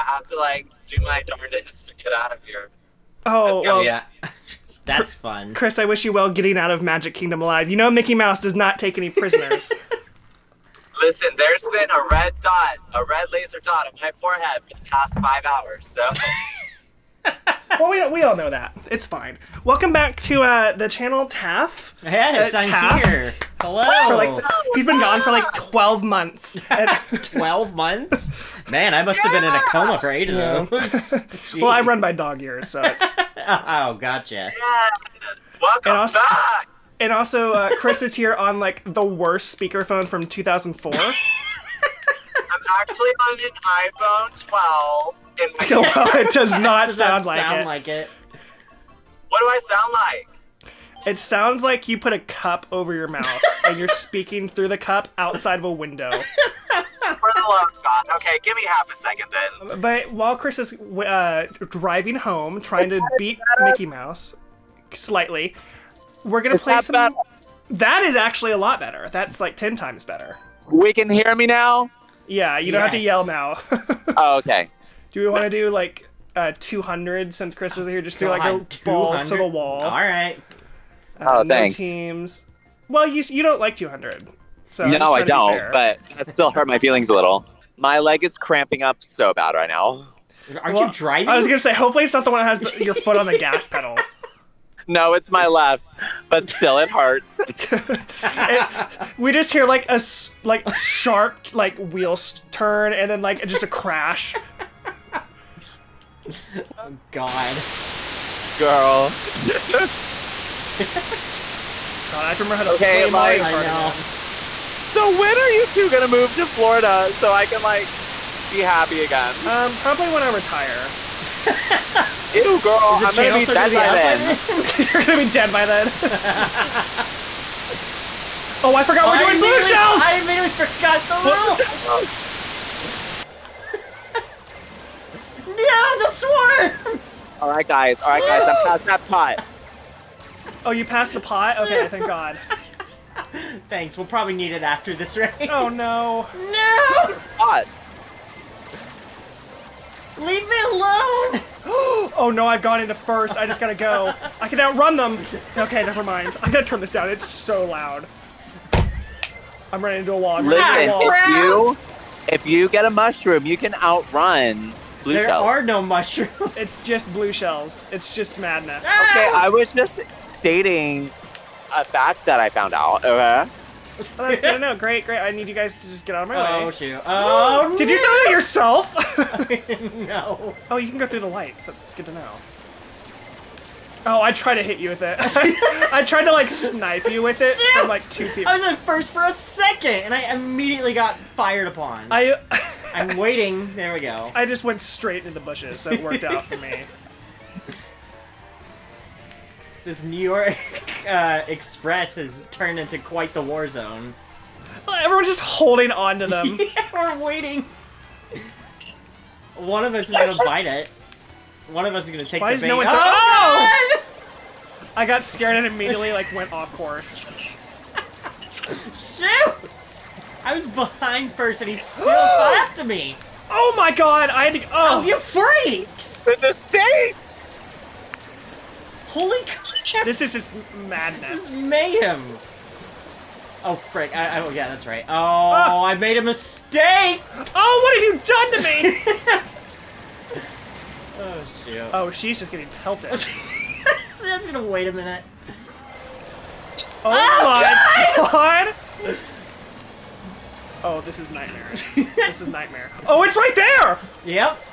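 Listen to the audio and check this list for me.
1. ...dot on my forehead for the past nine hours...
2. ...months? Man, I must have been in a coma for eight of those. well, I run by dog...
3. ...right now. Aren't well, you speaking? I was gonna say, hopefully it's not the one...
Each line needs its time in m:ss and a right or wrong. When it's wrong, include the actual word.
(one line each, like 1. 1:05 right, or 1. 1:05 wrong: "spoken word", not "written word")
1. 0:13 wrong: "five", not "nine"
2. 0:27 right
3. 1:29 wrong: "driving", not "speaking".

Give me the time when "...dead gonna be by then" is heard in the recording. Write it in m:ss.
2:03.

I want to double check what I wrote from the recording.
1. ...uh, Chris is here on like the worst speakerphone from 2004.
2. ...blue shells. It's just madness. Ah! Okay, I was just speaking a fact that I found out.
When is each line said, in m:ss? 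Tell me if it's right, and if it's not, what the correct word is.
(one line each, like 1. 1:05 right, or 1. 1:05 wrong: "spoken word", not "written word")
1. 0:37 right
2. 2:47 wrong: "stating", not "speaking".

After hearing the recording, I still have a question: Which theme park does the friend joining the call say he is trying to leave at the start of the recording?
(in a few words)
Magic Kingdom.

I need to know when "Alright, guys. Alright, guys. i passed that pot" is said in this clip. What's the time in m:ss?
2:17.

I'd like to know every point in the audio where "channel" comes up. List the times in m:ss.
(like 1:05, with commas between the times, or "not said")
0:20.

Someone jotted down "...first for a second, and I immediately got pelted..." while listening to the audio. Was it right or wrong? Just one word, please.
wrong.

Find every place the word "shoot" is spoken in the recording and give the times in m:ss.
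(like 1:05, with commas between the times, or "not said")
2:56, 3:07, 3:38, 4:01.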